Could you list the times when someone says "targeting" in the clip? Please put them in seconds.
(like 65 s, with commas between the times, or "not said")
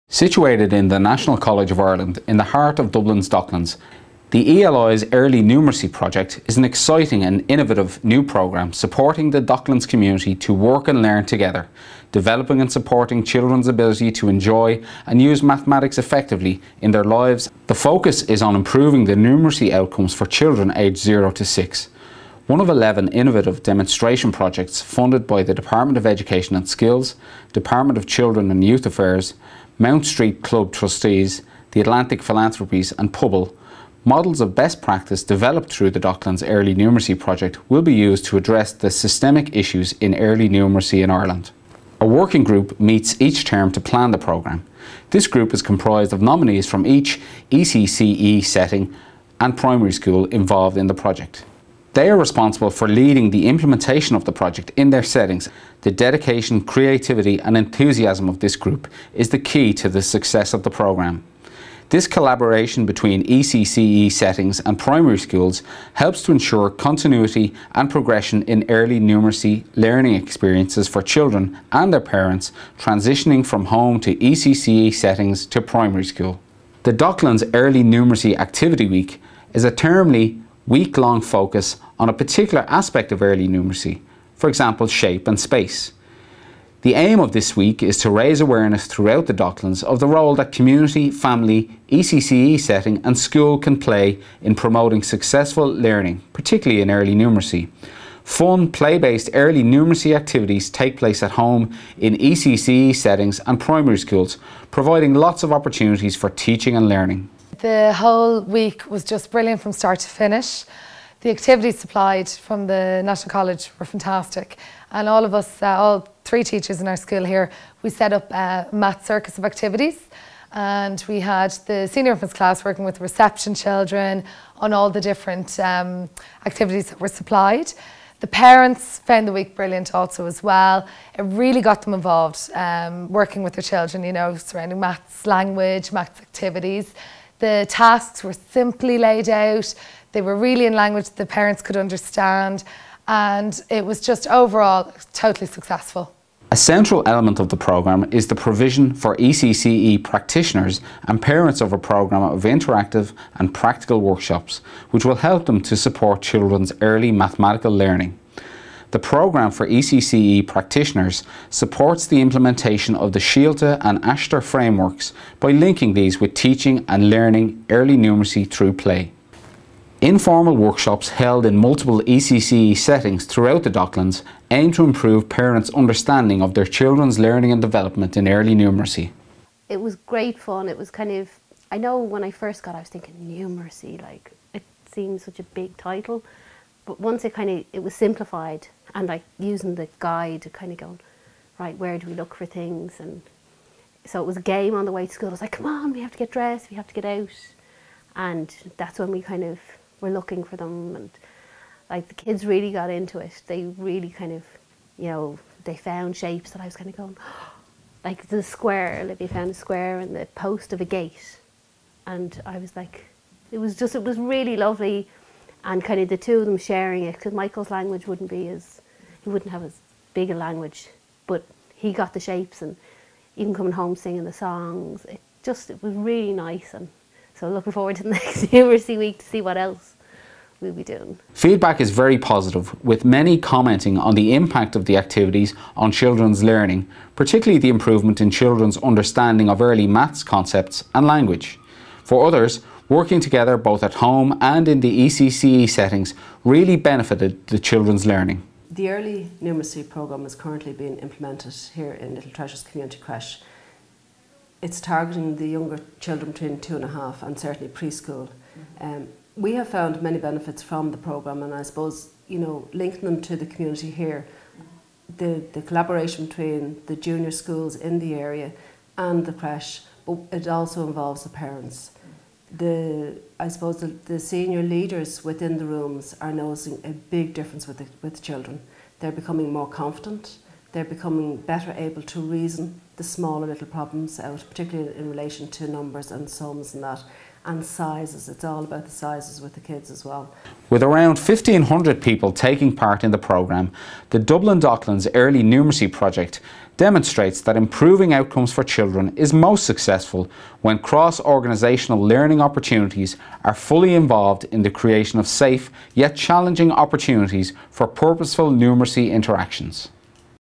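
254 s.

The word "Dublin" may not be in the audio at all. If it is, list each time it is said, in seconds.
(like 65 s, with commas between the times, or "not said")
2 s, 294 s.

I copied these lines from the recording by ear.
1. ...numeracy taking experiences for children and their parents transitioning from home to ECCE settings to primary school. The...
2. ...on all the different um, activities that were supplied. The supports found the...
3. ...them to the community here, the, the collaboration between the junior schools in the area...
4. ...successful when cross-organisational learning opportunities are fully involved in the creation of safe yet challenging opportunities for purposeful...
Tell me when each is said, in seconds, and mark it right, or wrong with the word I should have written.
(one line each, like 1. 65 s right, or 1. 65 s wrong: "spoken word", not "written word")
1. 69 s wrong: "learning", not "taking"
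2. 124 s wrong: "parents", not "supports"
3. 263 s right
4. 299 s right.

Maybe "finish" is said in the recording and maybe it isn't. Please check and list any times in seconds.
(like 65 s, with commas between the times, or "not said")
110 s.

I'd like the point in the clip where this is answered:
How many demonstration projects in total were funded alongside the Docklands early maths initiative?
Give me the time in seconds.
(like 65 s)
22 s.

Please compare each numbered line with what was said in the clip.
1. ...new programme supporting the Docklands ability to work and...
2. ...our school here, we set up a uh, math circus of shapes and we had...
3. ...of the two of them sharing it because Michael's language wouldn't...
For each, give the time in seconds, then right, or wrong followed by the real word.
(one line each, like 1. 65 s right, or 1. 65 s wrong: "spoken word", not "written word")
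1. 8 s wrong: "community", not "ability"
2. 116 s wrong: "activities", not "shapes"
3. 215 s right.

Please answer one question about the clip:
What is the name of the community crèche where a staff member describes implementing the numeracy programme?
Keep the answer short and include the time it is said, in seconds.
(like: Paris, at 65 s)
Little Treasures Community Crèche, at 252 s.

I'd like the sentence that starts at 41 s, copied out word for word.
A working group meets each term to plan the programme.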